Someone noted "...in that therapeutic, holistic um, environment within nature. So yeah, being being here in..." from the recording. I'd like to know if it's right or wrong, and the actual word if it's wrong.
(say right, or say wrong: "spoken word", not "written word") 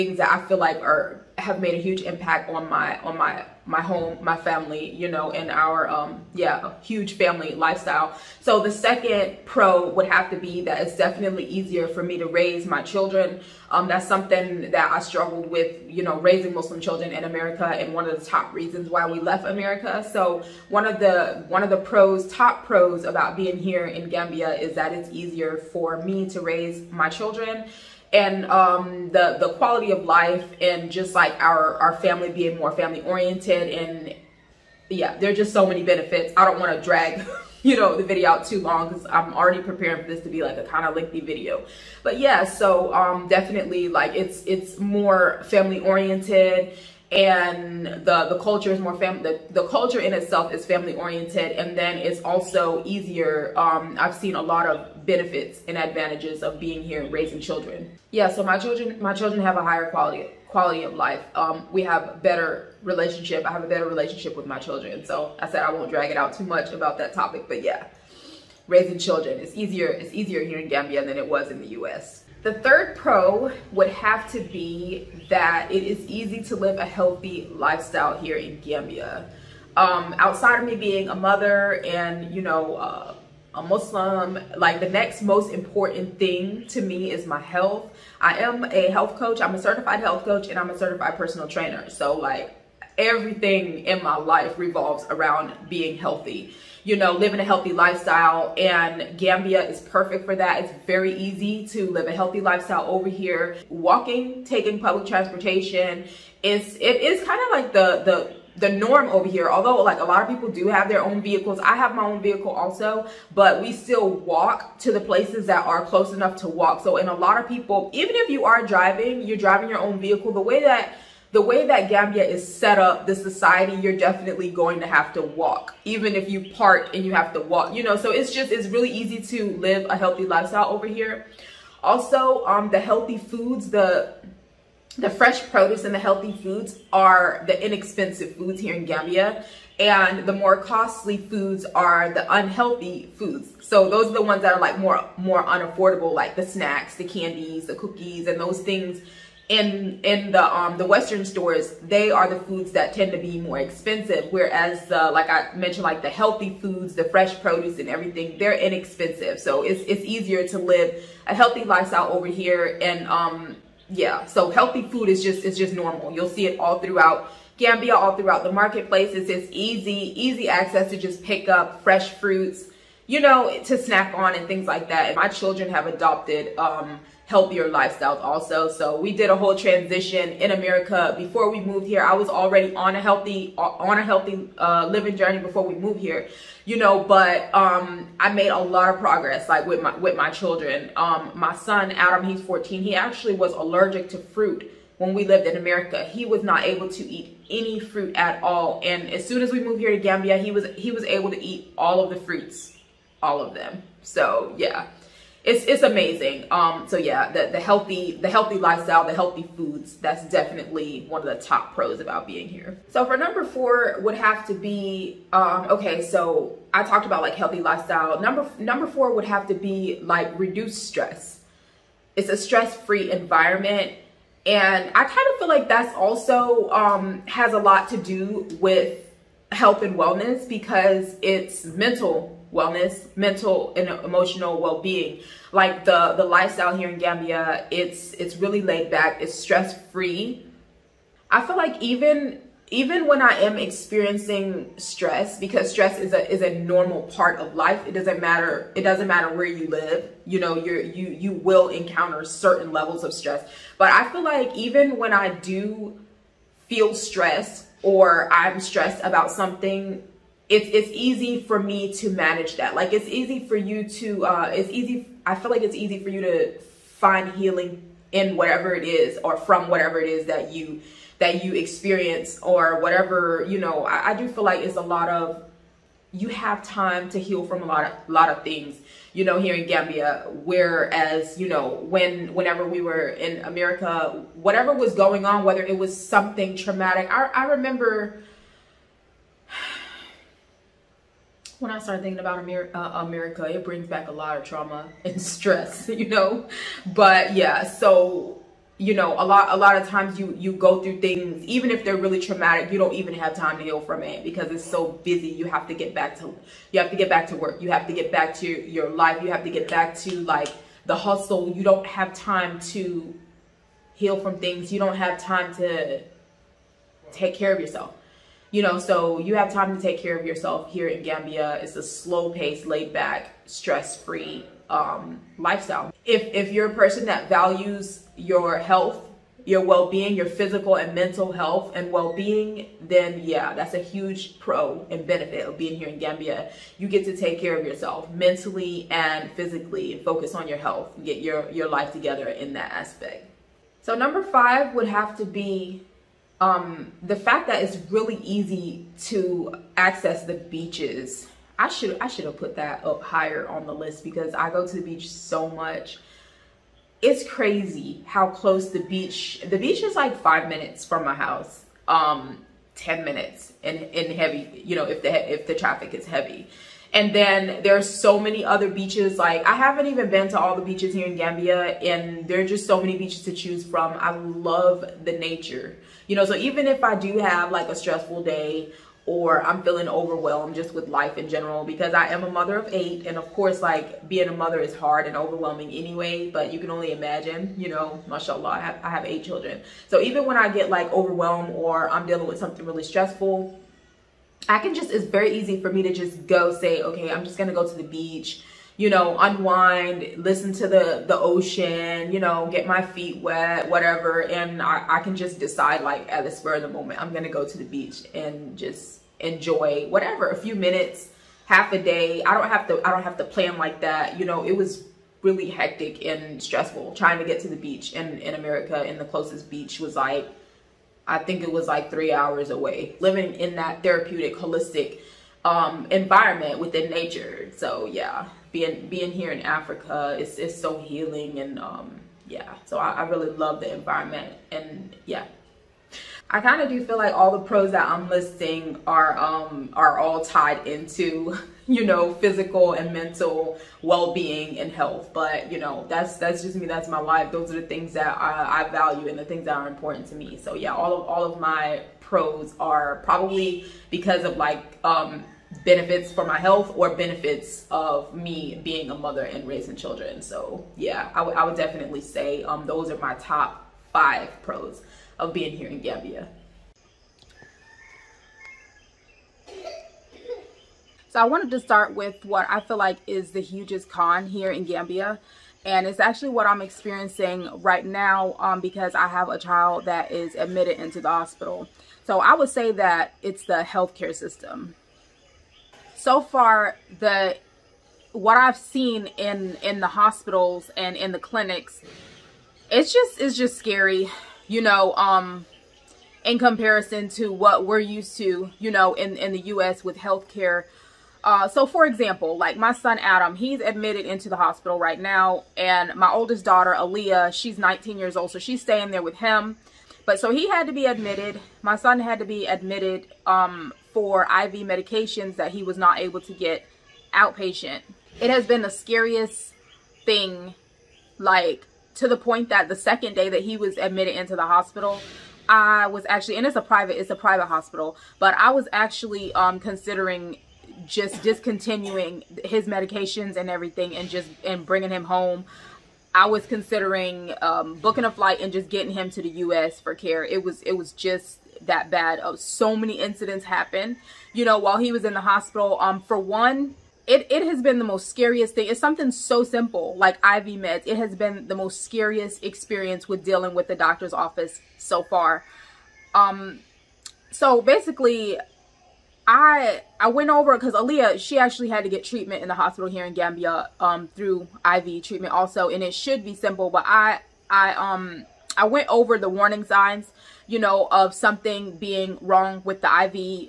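right.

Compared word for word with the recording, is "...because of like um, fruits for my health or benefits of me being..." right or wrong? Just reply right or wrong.
wrong.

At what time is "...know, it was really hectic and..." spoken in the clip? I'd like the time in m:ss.
6:54.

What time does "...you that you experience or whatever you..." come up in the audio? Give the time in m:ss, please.
4:30.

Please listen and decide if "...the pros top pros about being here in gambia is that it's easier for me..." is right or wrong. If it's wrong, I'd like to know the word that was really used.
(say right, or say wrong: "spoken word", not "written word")
right.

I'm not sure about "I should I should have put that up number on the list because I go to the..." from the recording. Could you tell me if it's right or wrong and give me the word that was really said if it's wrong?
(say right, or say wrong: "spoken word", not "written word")
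wrong: "higher", not "number".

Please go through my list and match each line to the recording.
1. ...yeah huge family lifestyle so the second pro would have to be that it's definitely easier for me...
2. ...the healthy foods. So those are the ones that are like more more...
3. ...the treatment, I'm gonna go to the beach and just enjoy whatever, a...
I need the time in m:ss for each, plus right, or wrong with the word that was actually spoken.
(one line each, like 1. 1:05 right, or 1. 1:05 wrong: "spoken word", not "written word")
1. 0:06 right
2. 2:22 wrong: "unhealthy", not "healthy"
3. 6:46 wrong: "moment", not "treatment".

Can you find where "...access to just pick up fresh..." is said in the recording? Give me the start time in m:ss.
2:50.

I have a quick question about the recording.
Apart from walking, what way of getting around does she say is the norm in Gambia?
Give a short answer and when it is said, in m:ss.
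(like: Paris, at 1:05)
public transportation, at 1:44.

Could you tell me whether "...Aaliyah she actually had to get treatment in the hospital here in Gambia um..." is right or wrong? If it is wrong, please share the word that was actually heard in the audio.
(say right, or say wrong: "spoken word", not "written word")
right.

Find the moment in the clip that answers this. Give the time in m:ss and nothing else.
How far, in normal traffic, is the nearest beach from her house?
6:00.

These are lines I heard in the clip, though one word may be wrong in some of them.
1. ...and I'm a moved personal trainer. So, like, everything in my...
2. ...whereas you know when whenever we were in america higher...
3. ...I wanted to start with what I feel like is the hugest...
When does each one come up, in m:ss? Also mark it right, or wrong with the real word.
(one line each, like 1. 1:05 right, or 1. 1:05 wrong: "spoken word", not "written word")
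1. 1:30 wrong: "certified", not "moved"
2. 4:40 wrong: "whatever", not "higher"
3. 7:51 right.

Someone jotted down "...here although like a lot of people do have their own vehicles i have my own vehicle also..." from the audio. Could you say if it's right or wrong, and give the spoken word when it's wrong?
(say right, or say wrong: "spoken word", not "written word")
right.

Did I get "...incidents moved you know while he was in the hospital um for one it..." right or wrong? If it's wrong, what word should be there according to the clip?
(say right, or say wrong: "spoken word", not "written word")
wrong: "happened", not "moved".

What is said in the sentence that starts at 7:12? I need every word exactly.
So I, I really love the environment and yeah.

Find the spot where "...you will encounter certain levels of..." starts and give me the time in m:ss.
4:11.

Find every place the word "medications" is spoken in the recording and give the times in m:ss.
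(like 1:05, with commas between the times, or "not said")
8:34, 8:52.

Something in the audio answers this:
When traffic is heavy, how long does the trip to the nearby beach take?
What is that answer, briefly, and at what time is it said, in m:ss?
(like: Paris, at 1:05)
10 minutes, at 6:02.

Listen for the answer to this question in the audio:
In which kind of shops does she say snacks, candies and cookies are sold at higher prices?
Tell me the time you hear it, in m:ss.
2:30.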